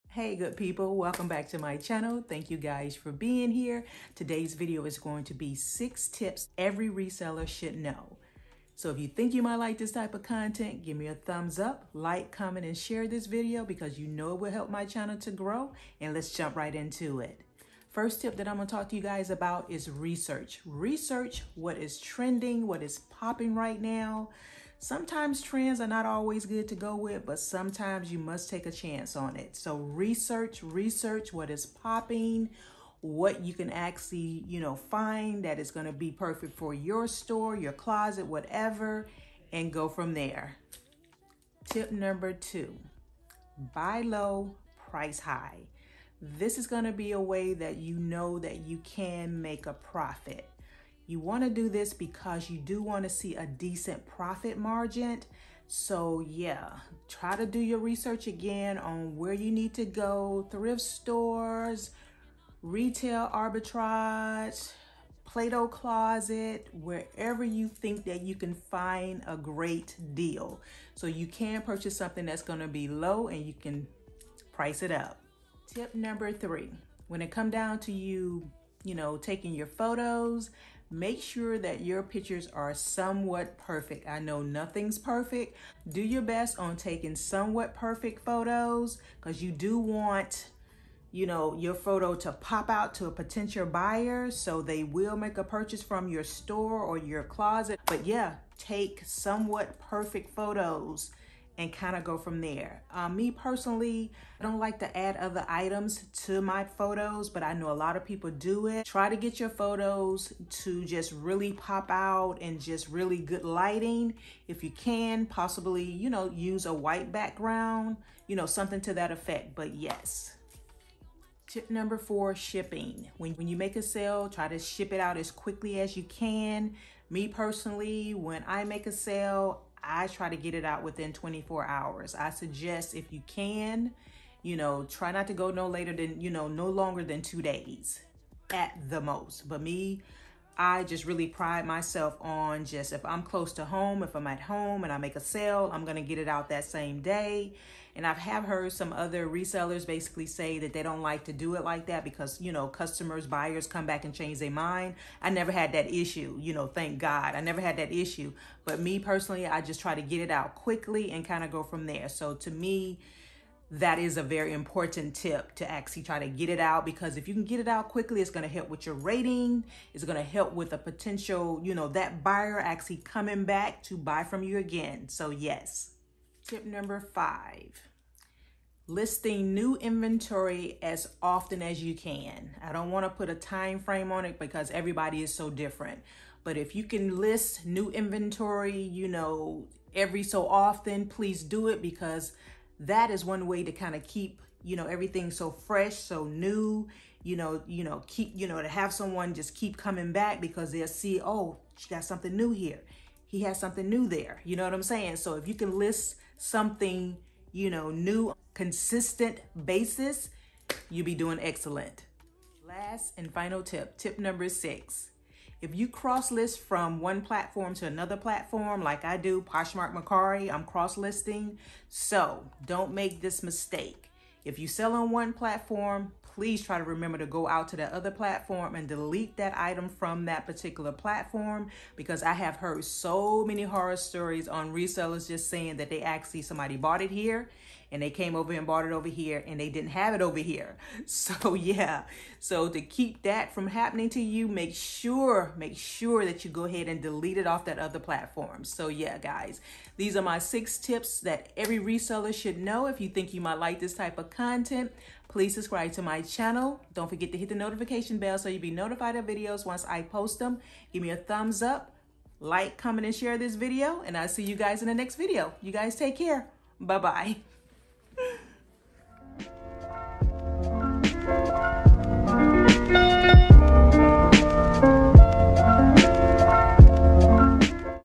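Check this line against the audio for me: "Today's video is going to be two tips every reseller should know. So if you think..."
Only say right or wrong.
wrong.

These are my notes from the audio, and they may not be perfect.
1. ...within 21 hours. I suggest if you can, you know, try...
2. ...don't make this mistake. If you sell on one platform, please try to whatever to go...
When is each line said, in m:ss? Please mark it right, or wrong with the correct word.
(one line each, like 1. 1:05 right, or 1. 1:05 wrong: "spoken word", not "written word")
1. 2:10 wrong: "24", not "21"
2. 3:42 wrong: "remember", not "whatever".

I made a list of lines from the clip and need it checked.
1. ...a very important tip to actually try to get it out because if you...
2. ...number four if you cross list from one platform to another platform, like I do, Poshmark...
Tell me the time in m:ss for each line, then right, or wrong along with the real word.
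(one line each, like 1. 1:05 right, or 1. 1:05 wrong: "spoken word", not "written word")
1. 2:44 right
2. 3:34 wrong: "six", not "four".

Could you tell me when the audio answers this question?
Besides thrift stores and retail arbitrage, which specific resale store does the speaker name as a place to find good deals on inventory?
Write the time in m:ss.
1:05.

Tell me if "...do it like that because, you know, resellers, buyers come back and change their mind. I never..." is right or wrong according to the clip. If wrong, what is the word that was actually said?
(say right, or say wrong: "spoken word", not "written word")
wrong: "customers", not "resellers".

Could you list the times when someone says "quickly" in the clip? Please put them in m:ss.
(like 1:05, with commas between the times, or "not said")
2:05, 2:40, 2:47.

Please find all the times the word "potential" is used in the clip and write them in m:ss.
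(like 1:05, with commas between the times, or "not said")
1:33, 2:50.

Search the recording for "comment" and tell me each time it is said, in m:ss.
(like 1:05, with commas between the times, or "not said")
0:12, 4:22.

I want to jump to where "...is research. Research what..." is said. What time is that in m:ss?
0:19.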